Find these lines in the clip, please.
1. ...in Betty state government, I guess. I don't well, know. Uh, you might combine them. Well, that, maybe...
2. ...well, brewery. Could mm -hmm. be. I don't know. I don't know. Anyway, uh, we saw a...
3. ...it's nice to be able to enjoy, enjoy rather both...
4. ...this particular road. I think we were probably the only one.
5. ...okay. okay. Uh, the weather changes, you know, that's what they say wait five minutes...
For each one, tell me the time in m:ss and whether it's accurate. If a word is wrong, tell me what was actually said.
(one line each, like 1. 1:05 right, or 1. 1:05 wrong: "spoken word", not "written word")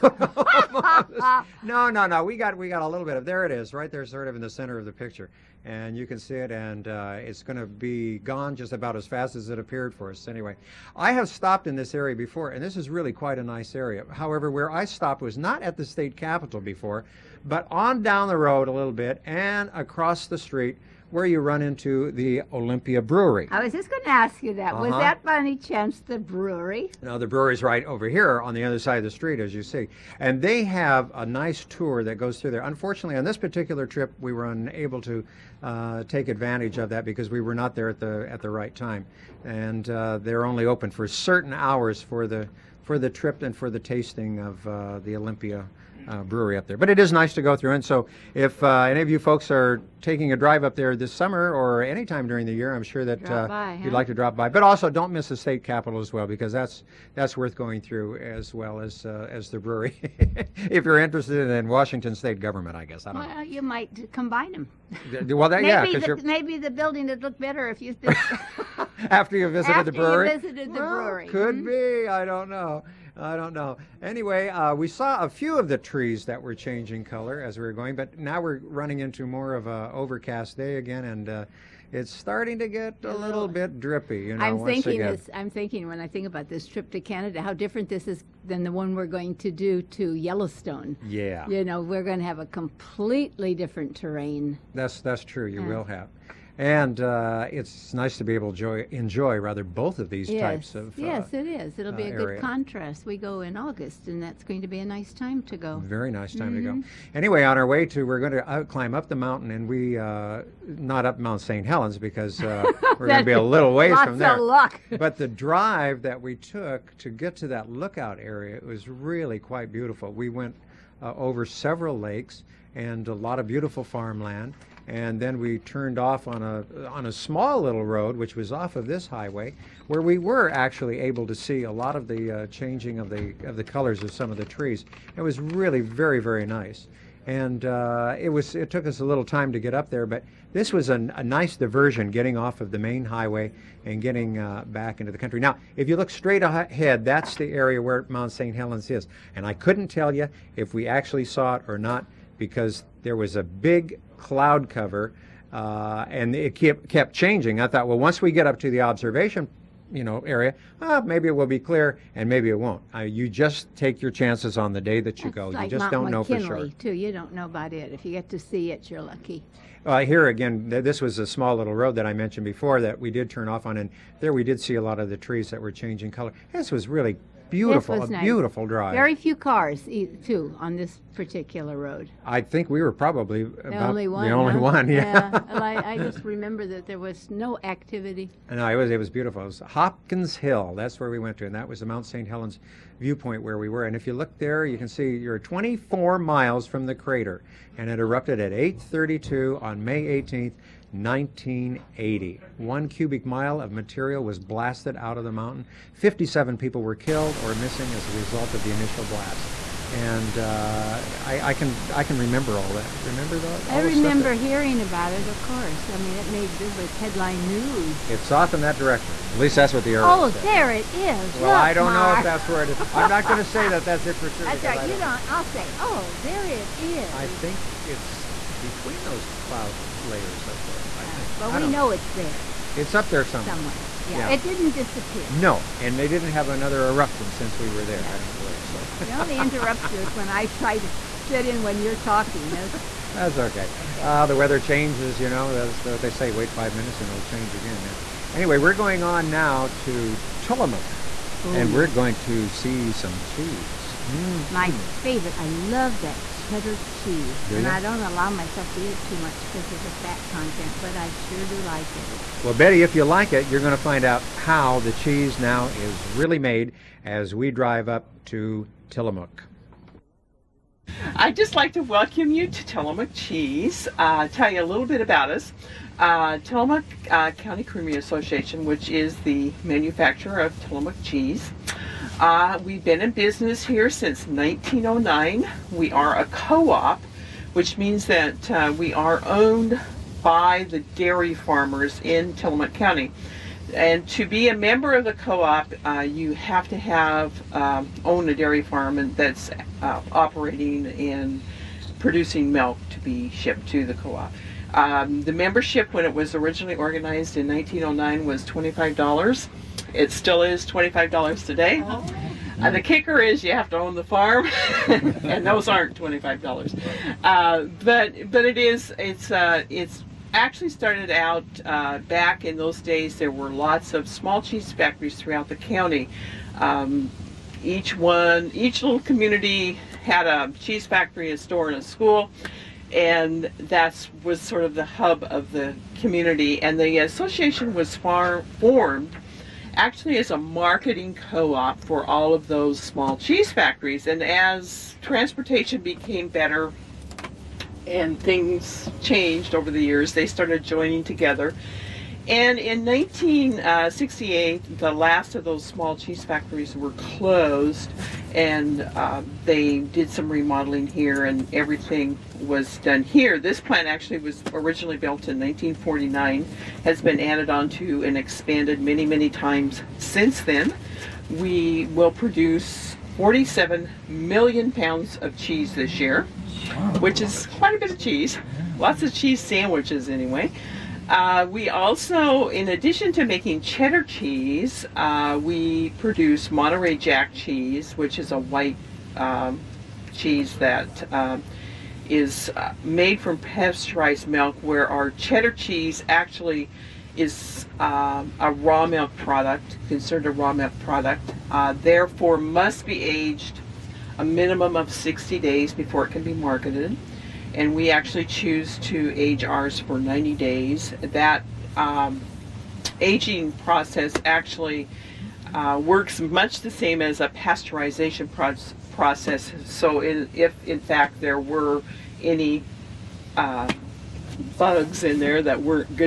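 1. 1:01 wrong: "Washington", not "Betty"
2. 1:10 right
3. 1:37 right
4. 3:00 right
5. 4:03 right.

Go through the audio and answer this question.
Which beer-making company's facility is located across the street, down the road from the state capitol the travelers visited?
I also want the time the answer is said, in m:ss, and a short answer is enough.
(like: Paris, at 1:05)
Olympia Brewery, at 0:22.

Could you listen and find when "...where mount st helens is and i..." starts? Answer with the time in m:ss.
2:27.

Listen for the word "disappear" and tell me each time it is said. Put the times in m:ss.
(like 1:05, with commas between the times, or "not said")
3:54.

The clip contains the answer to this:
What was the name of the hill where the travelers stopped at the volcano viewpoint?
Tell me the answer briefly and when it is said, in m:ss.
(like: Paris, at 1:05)
Hopkins Hill, at 3:09.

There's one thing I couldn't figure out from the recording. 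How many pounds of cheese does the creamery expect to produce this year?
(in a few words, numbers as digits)
47 million.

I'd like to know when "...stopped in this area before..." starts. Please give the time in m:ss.
0:11.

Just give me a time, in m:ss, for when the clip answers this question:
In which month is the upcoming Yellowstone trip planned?
1:43.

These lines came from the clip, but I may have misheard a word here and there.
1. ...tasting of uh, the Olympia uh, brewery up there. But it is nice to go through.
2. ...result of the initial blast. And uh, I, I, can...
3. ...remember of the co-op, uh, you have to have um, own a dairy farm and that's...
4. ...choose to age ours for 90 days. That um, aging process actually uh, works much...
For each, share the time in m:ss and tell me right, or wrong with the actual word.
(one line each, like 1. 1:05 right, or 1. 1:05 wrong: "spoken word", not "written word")
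1. 0:43 right
2. 3:28 right
3. 4:54 wrong: "member", not "remember"
4. 6:48 right.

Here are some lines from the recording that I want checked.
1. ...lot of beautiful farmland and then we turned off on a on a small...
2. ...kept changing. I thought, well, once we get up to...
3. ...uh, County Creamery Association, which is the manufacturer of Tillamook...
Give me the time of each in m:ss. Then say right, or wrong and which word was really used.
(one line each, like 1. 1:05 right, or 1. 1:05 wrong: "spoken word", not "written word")
1. 2:03 right
2. 2:36 right
3. 4:37 right.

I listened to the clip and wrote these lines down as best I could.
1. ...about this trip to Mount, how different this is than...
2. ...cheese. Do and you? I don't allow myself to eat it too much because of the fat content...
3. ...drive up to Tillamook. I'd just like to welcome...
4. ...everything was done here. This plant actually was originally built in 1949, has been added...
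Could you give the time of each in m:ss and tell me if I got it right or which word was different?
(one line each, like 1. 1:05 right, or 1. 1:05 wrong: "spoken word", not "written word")
1. 1:26 wrong: "Canada", not "Mount"
2. 4:16 right
3. 4:27 right
4. 6:01 right.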